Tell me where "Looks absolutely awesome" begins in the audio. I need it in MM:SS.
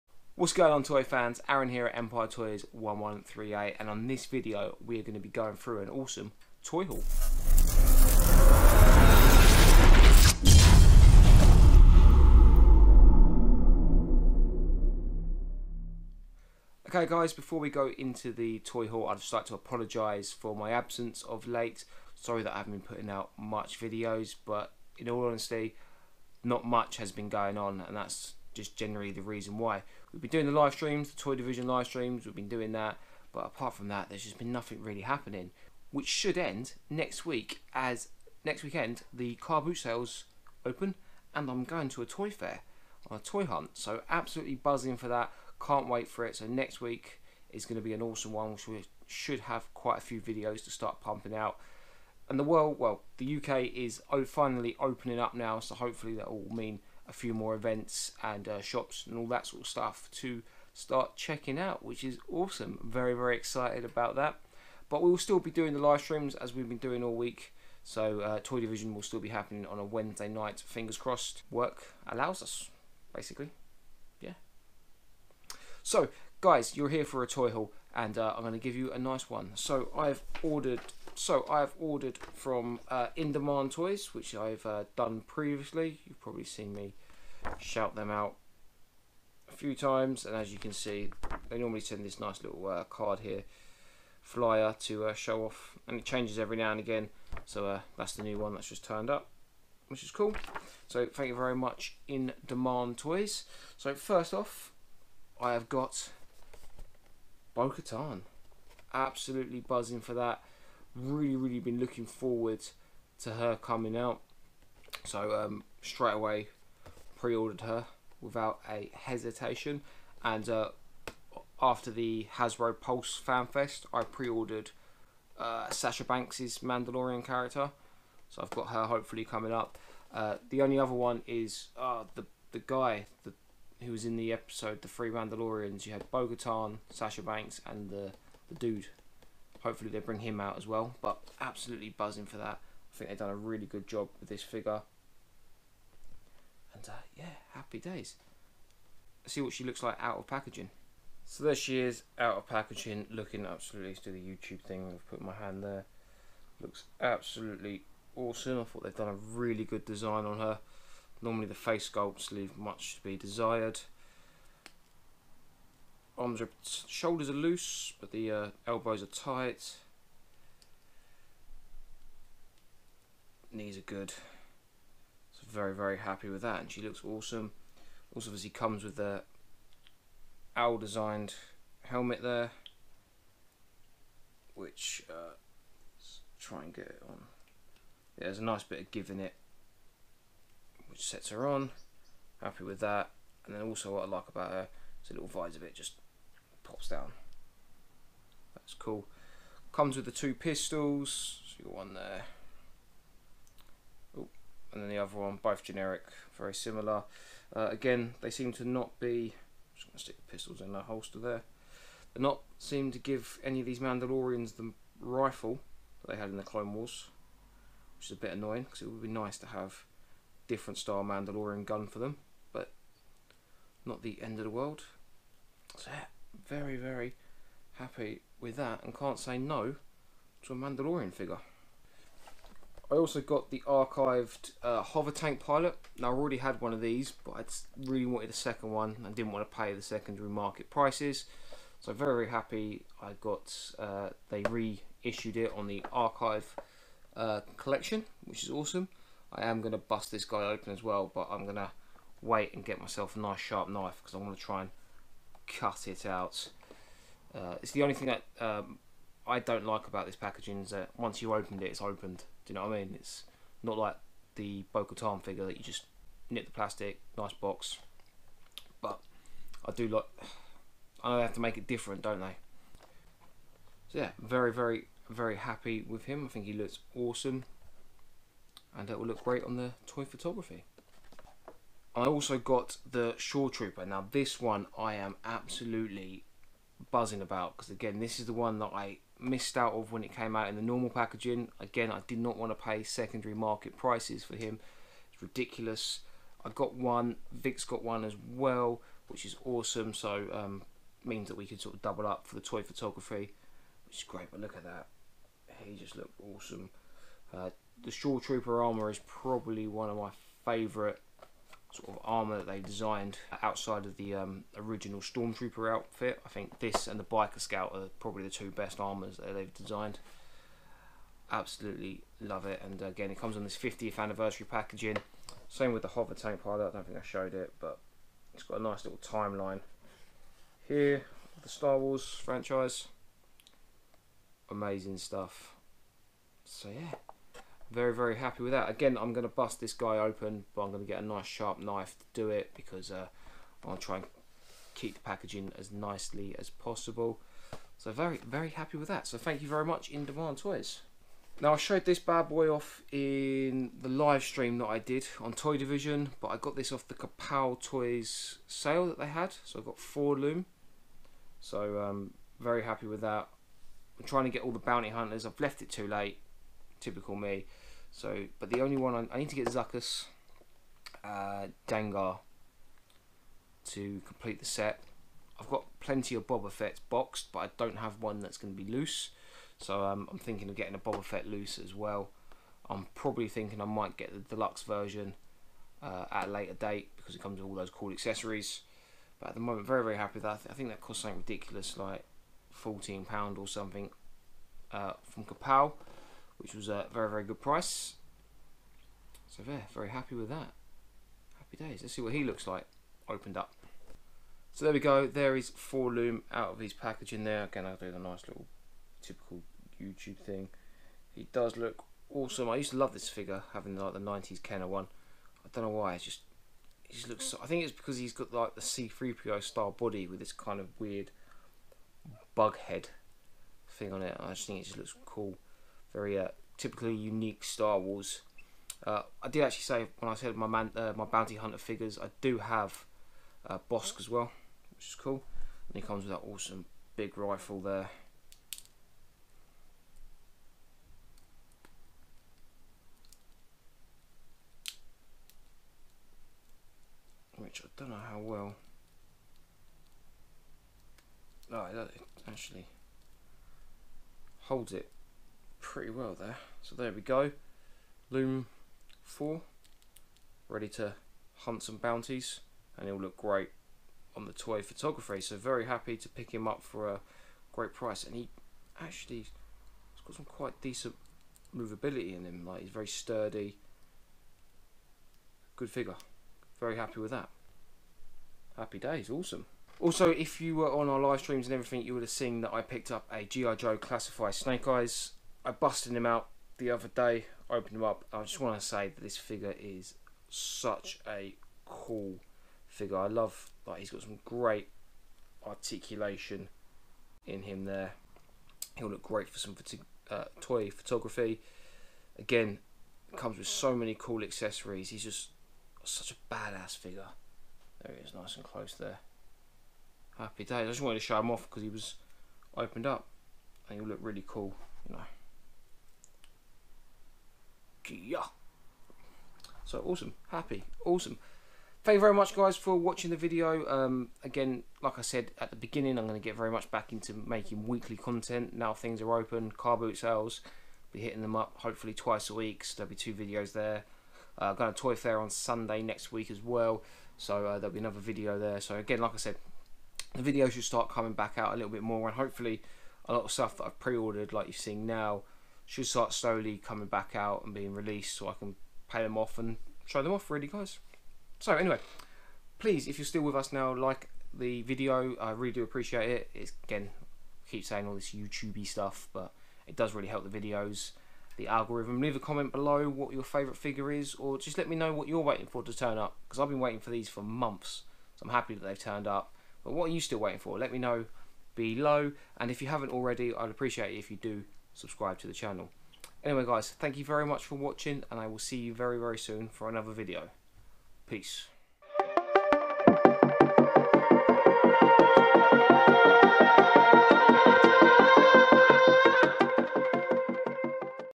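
02:36.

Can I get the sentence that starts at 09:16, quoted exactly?
It's again I keep saying all this YouTubey stuff but it does really help the videos the algorithm.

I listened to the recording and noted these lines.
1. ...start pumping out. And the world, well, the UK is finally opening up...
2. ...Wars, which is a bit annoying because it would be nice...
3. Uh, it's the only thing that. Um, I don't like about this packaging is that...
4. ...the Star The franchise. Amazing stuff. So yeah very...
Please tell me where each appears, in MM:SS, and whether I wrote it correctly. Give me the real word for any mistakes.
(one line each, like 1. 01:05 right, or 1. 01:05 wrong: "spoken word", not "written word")
1. 00:50 right
2. 03:36 right
3. 04:17 right
4. 05:31 wrong: "Wars", not "The".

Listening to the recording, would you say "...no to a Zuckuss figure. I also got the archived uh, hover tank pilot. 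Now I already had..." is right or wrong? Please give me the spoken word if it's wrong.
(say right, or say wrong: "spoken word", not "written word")
wrong: "Mandalorian", not "Zuckuss".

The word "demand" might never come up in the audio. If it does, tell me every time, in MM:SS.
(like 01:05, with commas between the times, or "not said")
01:23, 01:42, 05:50.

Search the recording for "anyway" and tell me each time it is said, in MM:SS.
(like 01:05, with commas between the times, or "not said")
09:11, 09:36.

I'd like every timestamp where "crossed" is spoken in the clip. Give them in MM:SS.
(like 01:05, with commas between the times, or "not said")
01:10.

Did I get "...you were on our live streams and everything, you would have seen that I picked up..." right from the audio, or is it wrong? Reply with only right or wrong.
right.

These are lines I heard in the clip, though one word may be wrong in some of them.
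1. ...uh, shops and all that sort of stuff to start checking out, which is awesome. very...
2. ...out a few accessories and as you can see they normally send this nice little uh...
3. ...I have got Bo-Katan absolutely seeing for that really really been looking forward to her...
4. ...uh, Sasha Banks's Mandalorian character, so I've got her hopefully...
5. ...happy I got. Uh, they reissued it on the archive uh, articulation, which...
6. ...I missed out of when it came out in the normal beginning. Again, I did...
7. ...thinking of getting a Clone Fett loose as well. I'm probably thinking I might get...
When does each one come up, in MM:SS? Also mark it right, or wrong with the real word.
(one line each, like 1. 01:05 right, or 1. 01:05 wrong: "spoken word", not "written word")
1. 00:58 right
2. 01:28 wrong: "times", not "accessories"
3. 01:45 wrong: "buzzing", not "seeing"
4. 02:05 right
5. 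04:02 wrong: "collection", not "articulation"
6. 04:48 wrong: "packaging", not "beginning"
7. 06:20 wrong: "Boba", not "Clone".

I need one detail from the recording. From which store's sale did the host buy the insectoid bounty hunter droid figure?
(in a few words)
Kapow Toys.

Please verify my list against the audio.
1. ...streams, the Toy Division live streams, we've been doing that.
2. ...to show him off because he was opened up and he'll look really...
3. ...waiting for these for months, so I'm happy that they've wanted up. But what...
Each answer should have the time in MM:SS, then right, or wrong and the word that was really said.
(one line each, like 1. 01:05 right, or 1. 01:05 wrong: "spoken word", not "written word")
1. 00:30 right
2. 08:30 right
3. 09:26 wrong: "turned", not "wanted".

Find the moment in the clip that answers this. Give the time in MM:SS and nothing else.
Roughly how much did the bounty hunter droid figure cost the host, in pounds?
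06:32.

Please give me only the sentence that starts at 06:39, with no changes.
So there, very happy with that.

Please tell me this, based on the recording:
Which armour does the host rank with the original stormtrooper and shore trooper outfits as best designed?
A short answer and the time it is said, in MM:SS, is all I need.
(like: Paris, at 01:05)
Biker scout, at 05:17.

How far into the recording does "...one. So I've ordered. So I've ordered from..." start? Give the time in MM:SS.
01:19.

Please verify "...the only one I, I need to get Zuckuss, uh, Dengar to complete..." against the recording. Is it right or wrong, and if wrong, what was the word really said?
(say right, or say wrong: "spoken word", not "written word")
right.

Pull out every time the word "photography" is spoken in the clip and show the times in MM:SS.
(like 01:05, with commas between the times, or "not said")
04:40, 05:02, 07:44, 08:20.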